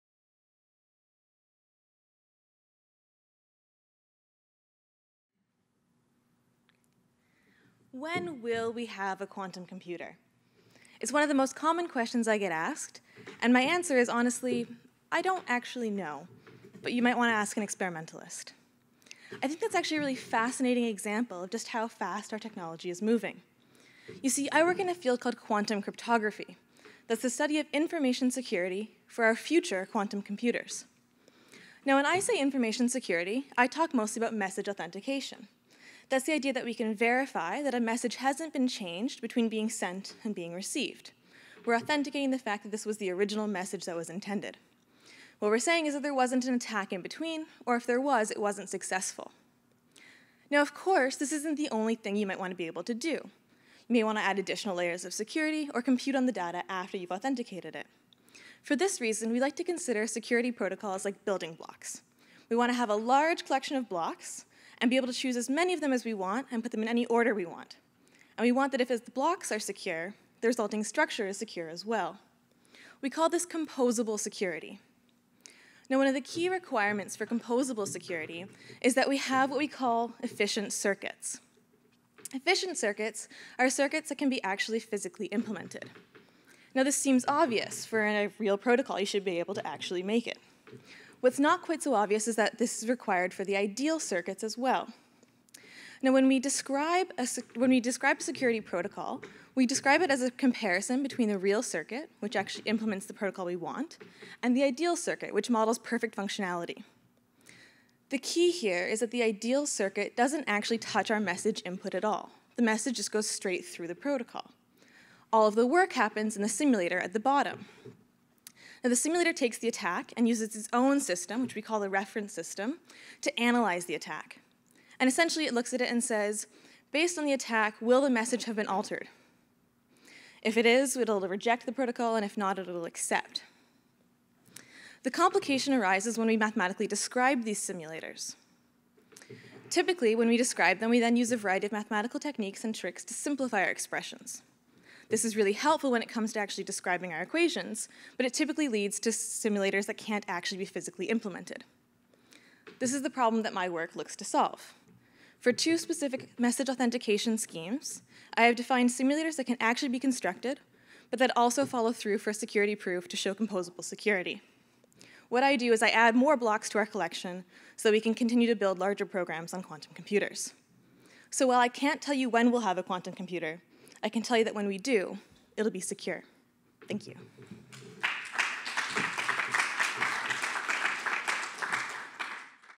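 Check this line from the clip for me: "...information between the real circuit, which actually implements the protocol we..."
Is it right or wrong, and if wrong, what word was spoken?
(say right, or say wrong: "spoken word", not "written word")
wrong: "comparison", not "information".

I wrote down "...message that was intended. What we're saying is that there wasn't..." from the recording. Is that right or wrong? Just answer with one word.
right.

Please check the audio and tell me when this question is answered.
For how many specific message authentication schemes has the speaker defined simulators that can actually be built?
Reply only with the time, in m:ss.
2:35.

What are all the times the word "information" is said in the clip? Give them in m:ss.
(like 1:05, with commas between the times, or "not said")
0:27, 0:32.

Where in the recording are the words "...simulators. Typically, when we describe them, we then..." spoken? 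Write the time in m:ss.
2:17.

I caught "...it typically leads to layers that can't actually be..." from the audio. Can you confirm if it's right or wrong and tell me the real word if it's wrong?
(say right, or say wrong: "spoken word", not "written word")
wrong: "simulators", not "layers".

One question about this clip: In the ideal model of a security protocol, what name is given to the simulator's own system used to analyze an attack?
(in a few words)
Reference system.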